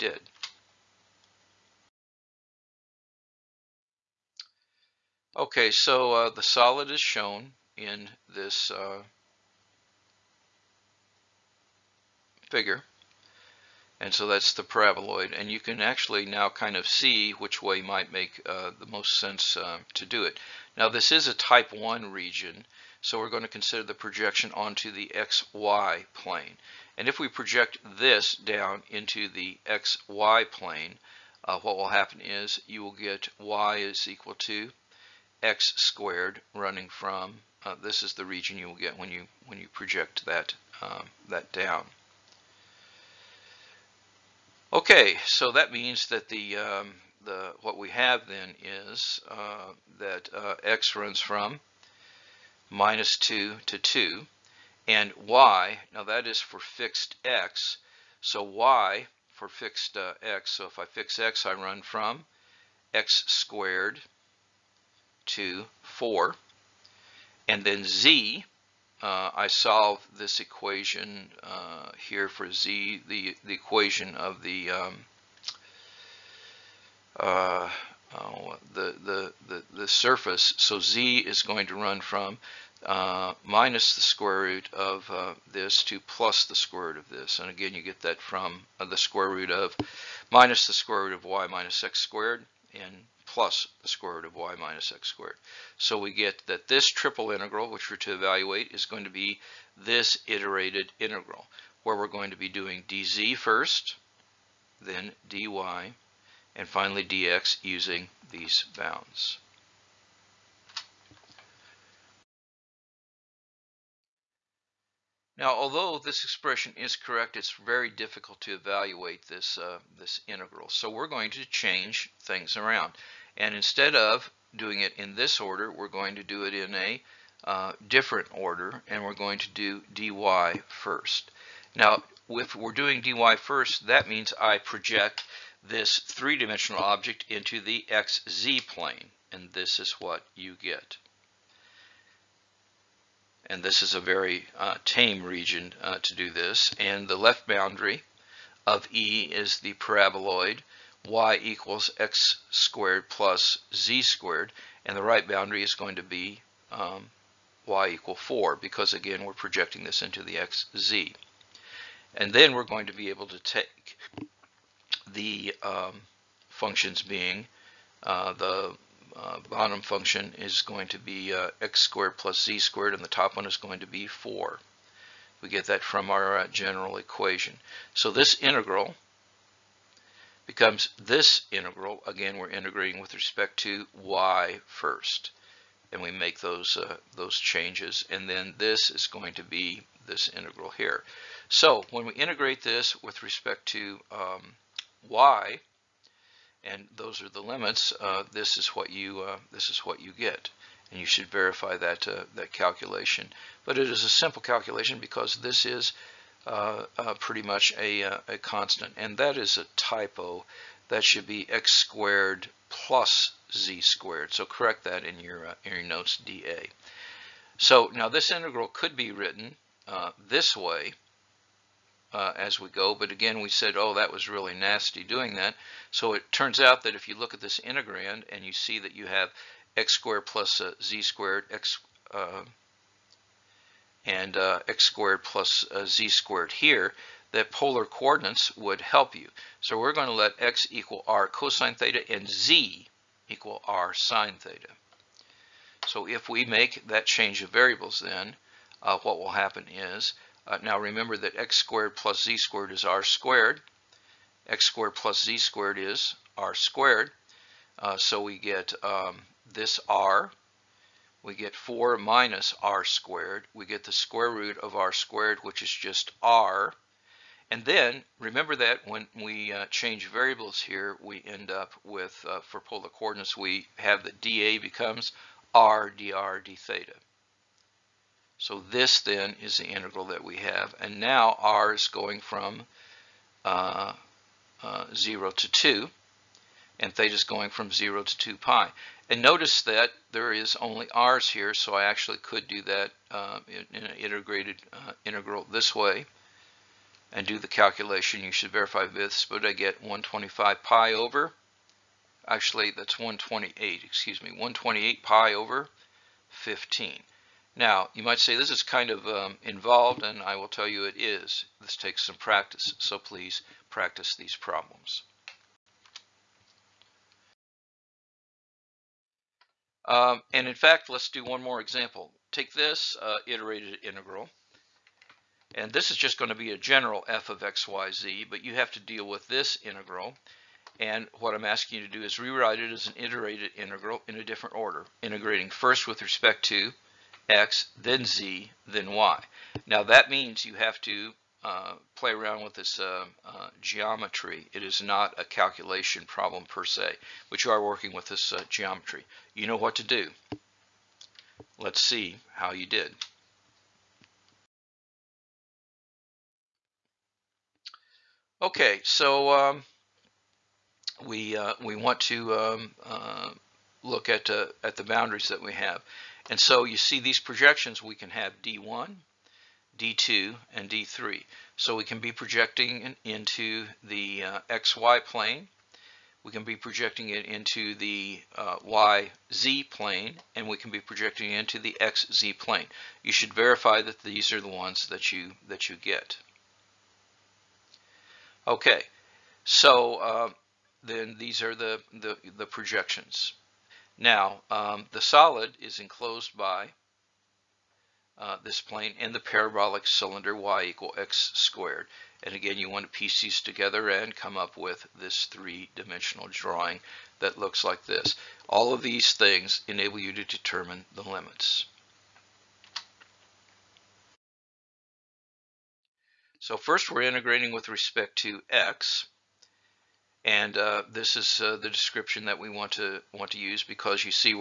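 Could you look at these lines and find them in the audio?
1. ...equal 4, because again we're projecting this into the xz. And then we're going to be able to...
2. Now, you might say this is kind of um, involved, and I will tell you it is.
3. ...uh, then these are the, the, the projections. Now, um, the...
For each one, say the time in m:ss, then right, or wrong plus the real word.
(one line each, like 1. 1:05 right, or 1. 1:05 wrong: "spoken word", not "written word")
1. 2:37 right
2. 5:07 right
3. 6:29 right.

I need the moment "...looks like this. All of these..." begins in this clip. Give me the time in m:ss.
6:47.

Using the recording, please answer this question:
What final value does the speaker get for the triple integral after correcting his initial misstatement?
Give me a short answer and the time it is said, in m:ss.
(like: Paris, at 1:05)
128 pi over 15, at 5:04.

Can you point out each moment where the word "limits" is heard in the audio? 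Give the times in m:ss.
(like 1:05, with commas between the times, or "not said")
3:17, 6:51.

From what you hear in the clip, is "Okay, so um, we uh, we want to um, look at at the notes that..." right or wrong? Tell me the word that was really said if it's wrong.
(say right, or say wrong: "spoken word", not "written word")
wrong: "boundaries", not "notes".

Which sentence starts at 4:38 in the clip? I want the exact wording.
So this then is the integral that we have.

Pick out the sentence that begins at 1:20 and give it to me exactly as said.
So z is going to run from uh, minus the square root of uh, this to plus the square root of this.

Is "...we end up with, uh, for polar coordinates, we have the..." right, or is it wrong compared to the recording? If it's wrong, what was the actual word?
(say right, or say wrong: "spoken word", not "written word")
right.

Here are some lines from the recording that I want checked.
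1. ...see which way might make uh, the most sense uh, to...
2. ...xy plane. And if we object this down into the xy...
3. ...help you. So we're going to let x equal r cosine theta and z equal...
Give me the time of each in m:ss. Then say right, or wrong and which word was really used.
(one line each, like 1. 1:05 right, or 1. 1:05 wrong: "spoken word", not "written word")
1. 0:16 right
2. 0:25 wrong: "project", not "object"
3. 3:58 right.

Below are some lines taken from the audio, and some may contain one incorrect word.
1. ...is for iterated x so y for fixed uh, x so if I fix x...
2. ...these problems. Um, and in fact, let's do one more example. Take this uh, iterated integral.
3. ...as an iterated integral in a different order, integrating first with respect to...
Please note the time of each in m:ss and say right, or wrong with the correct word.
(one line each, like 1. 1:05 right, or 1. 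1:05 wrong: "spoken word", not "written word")
1. 0:56 wrong: "fixed", not "iterated"
2. 5:14 right
3. 5:32 right.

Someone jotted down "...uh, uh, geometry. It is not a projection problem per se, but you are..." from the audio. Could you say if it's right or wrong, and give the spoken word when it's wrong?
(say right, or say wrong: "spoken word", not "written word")
wrong: "calculation", not "projection".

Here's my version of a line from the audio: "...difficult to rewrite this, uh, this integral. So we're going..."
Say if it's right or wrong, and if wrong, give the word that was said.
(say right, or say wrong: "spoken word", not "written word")
wrong: "evaluate", not "rewrite".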